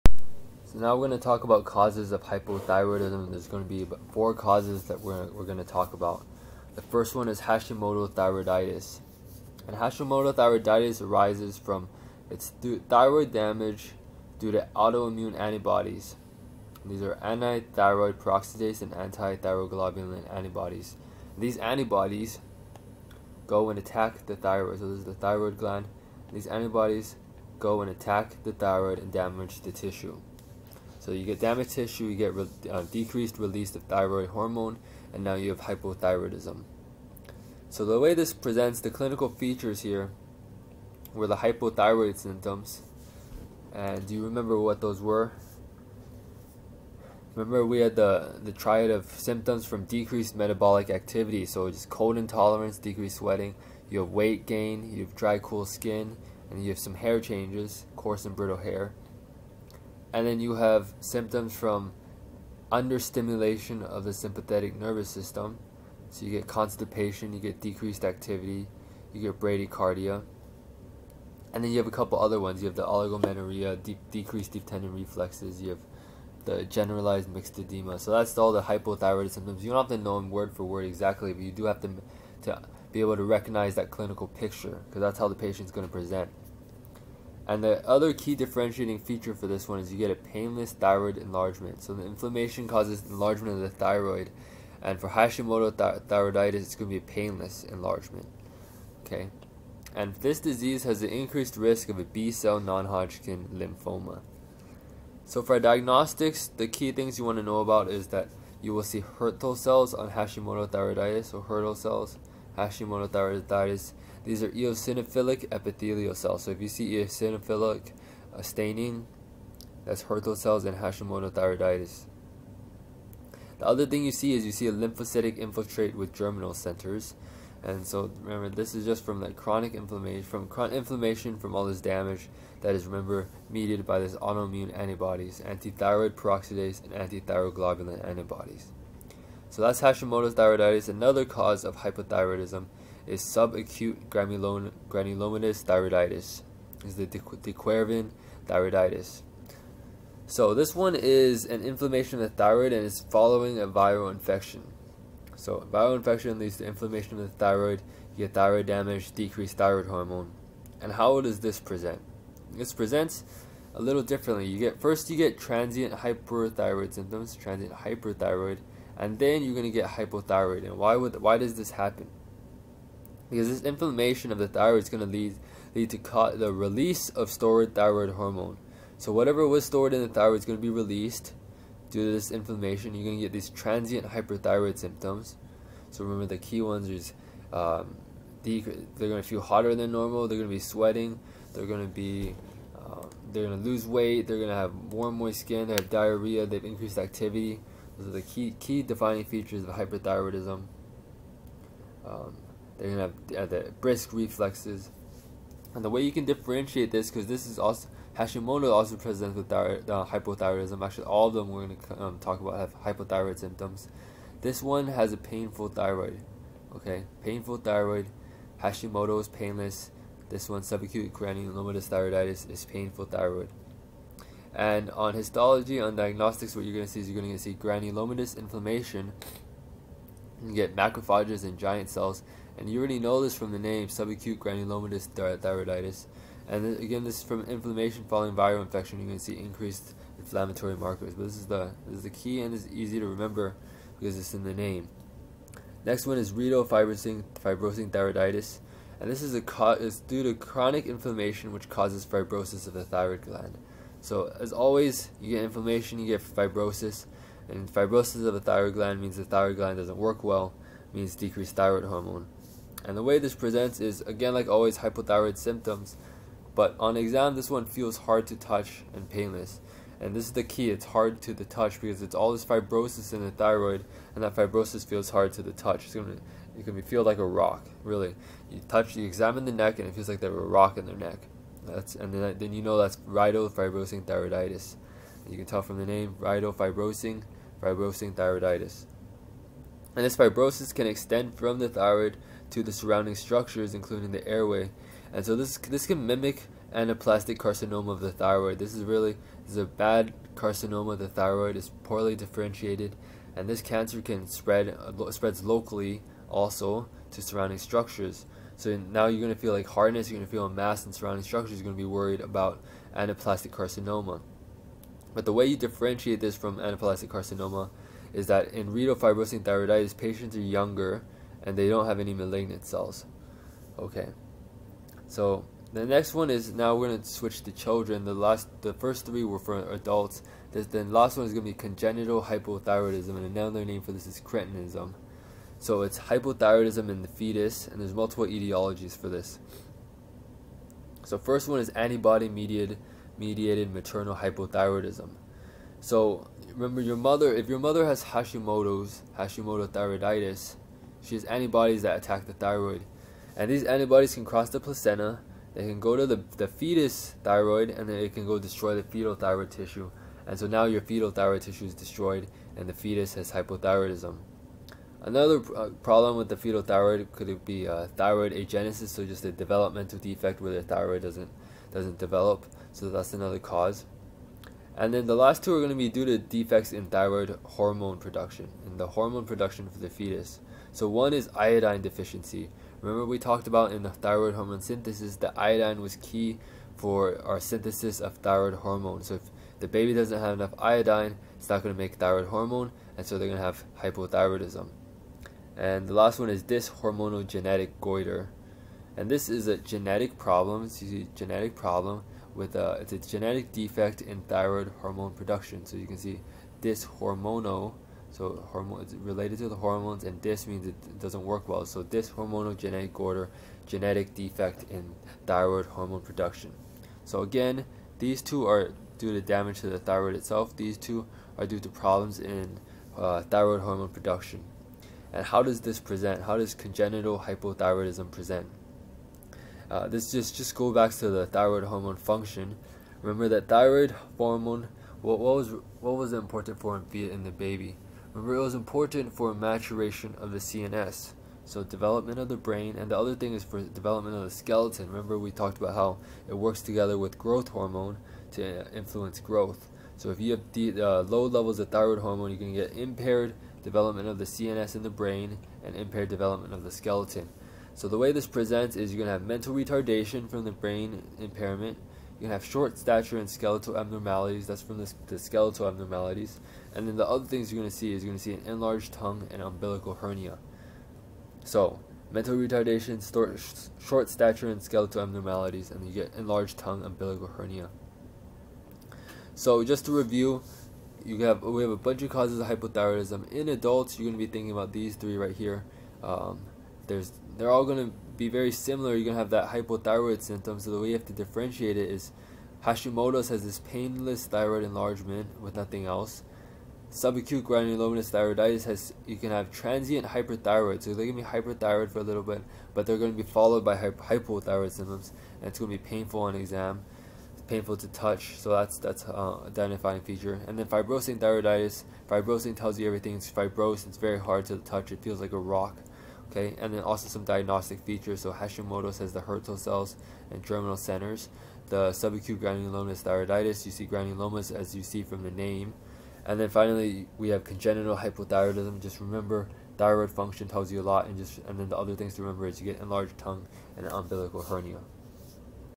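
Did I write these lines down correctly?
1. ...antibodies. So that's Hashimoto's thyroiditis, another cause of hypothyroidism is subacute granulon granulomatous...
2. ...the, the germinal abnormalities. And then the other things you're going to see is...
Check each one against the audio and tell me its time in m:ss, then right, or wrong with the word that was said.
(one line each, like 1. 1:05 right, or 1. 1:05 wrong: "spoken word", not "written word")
1. 2:18 right
2. 7:44 wrong: "skeletal", not "germinal".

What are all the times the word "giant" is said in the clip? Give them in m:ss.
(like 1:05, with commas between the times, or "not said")
3:51.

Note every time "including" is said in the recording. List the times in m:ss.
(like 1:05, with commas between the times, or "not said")
4:53.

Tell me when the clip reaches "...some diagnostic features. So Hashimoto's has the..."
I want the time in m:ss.
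8:37.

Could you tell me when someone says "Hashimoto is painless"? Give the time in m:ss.
3:38.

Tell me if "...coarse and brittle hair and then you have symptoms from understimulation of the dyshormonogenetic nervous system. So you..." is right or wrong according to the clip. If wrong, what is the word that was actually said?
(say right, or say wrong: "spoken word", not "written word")
wrong: "sympathetic", not "dyshormonogenetic".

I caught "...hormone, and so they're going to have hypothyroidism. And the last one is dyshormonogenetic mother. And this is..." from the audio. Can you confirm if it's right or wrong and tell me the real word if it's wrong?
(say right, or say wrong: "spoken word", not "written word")
wrong: "goiter", not "mother".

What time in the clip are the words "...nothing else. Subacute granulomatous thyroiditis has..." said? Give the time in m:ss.
8:15.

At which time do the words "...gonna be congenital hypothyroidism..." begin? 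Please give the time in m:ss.
5:31.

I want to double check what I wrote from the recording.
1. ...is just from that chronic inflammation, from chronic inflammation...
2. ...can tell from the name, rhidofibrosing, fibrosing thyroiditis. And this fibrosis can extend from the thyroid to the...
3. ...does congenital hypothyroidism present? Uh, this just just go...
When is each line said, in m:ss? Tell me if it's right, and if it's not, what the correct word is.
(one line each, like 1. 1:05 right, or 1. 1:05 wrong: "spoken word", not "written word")
1. 2:08 right
2. 4:45 right
3. 7:06 right.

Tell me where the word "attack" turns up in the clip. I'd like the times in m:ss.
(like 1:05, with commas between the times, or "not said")
0:23, 0:27, 5:51.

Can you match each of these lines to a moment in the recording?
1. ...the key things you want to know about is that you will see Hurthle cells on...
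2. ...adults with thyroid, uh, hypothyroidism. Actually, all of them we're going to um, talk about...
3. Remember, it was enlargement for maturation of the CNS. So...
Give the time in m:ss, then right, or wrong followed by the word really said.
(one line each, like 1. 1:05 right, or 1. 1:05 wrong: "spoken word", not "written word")
1. 1:46 right
2. 3:28 wrong: "presents", not "adults"
3. 7:18 wrong: "important", not "enlargement".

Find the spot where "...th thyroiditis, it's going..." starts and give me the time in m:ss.
1:35.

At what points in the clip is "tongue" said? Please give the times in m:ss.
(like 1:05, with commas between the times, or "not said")
7:48, 7:56, 8:53.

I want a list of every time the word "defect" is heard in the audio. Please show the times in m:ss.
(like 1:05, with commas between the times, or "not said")
6:09, 6:16, 6:43, 6:54.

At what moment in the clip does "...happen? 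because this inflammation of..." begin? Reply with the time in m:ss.
2:51.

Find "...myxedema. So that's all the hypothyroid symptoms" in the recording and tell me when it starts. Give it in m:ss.
1:17.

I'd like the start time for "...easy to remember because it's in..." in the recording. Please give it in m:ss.
4:02.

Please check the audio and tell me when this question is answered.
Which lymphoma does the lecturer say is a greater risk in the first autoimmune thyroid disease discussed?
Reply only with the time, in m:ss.
1:42.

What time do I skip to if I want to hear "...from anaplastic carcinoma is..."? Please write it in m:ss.
5:16.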